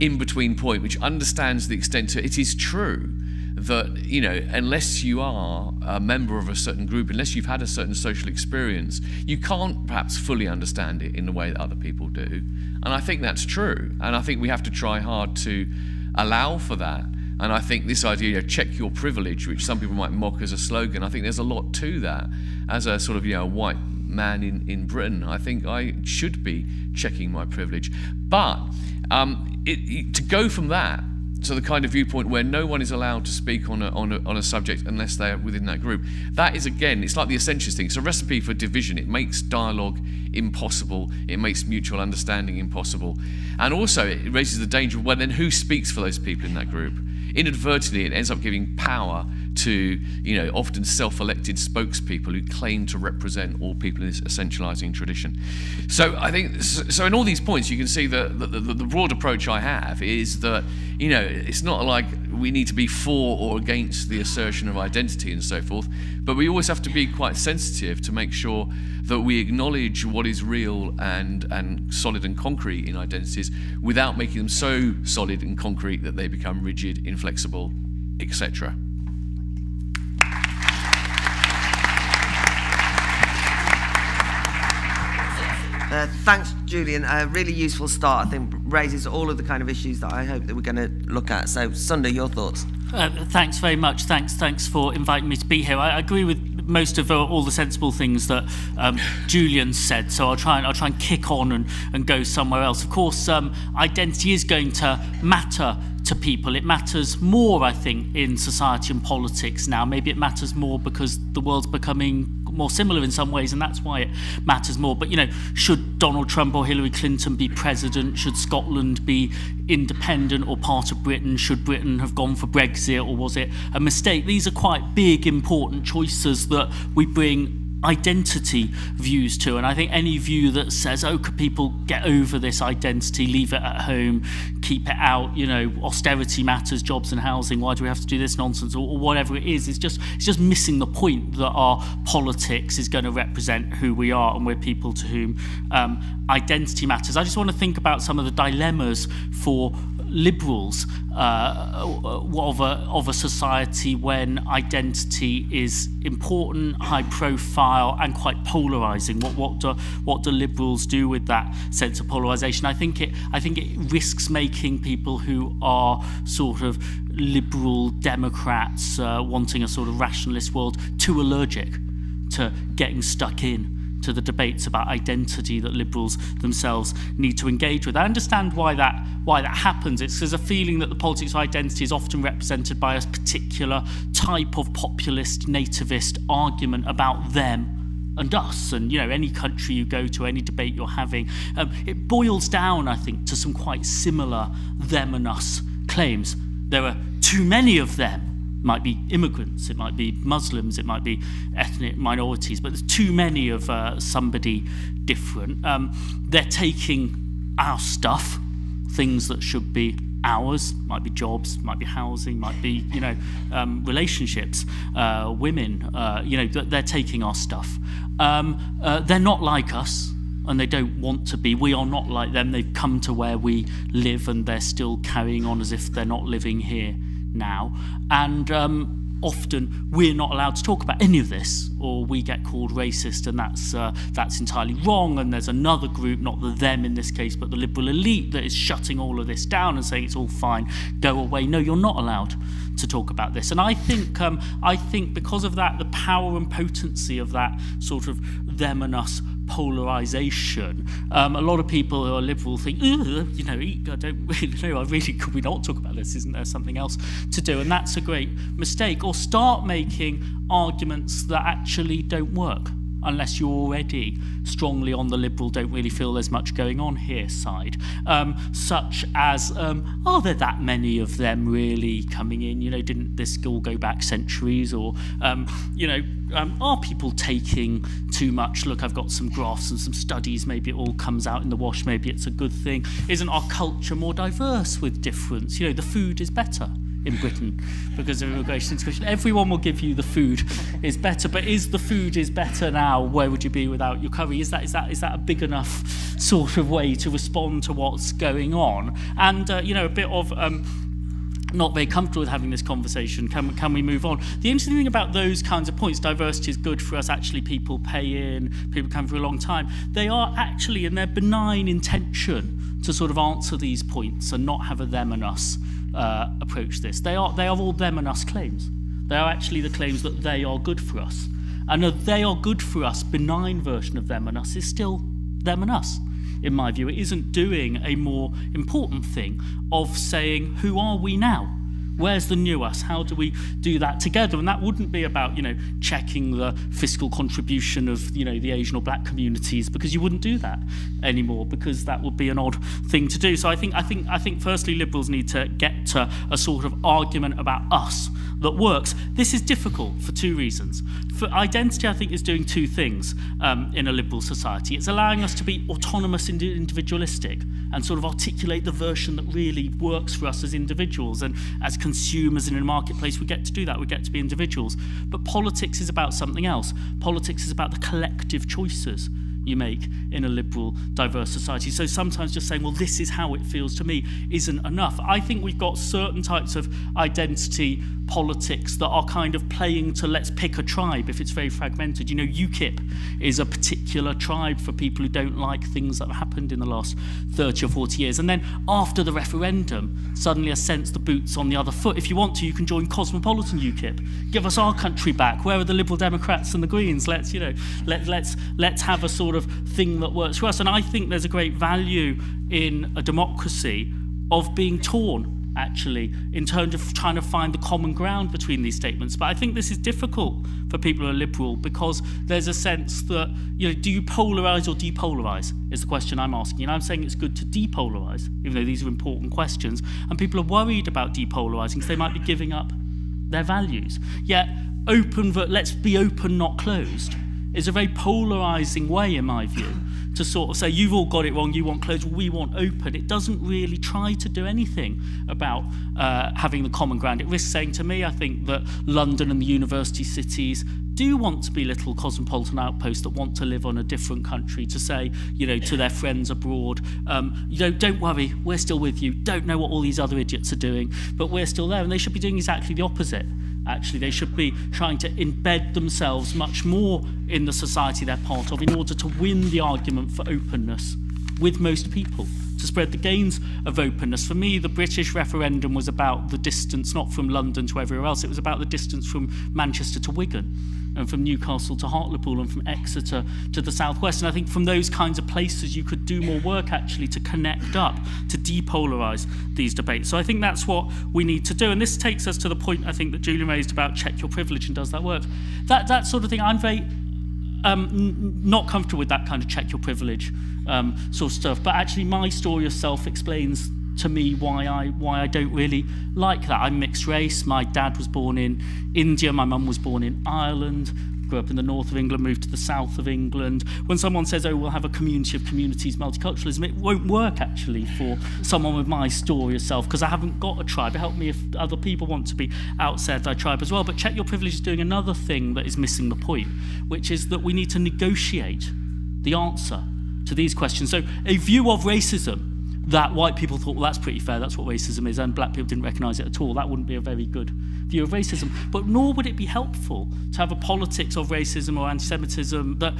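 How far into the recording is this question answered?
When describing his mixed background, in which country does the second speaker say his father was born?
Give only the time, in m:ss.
8:18.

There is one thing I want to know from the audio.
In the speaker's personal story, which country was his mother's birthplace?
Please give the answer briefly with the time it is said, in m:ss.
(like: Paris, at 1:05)
Ireland, at 8:20.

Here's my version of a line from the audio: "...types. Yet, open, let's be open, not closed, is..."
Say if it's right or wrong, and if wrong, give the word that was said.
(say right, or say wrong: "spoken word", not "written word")
wrong: "values", not "types".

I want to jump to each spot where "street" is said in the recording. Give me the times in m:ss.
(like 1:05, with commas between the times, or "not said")
not said.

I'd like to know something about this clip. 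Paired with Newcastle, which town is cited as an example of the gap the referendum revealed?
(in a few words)
Hartlepool.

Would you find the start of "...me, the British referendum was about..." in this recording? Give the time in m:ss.
7:44.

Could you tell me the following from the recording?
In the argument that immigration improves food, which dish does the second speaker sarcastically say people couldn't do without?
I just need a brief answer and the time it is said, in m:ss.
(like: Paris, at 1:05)
Curry, at 4:54.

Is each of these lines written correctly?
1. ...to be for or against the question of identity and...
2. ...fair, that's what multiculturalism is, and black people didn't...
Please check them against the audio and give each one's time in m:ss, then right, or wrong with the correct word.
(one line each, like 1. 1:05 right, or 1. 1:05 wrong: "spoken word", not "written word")
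1. 1:02 wrong: "assertion", not "question"
2. 8:44 wrong: "racism", not "multiculturalism".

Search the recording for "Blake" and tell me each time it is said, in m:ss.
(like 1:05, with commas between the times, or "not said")
not said.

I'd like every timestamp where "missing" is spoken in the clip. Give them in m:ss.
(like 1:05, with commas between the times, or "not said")
2:20, 8:35.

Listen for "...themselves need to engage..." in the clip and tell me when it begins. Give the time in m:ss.
2:56.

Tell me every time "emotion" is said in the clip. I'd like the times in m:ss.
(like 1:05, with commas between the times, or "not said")
not said.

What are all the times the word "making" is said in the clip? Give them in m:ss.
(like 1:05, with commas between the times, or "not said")
1:14, 2:44, 4:19.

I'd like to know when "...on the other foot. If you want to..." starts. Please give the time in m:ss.
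6:31.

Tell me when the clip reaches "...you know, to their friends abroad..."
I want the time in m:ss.
7:25.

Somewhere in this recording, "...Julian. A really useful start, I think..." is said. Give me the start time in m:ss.
1:26.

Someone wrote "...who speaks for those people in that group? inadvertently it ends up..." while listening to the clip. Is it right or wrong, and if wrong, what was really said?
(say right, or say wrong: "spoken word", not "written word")
right.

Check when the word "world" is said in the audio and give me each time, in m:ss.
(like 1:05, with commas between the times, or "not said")
1:51, 2:50.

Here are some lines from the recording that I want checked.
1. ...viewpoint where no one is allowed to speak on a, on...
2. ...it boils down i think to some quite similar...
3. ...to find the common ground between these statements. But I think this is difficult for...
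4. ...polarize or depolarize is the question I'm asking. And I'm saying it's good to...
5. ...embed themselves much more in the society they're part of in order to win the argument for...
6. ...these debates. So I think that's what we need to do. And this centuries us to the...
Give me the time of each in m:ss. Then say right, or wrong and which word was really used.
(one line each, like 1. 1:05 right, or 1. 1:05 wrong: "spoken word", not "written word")
1. 0:31 right
2. 3:11 right
3. 6:47 right
4. 6:54 right
5. 7:35 right
6. 7:59 wrong: "takes", not "centuries".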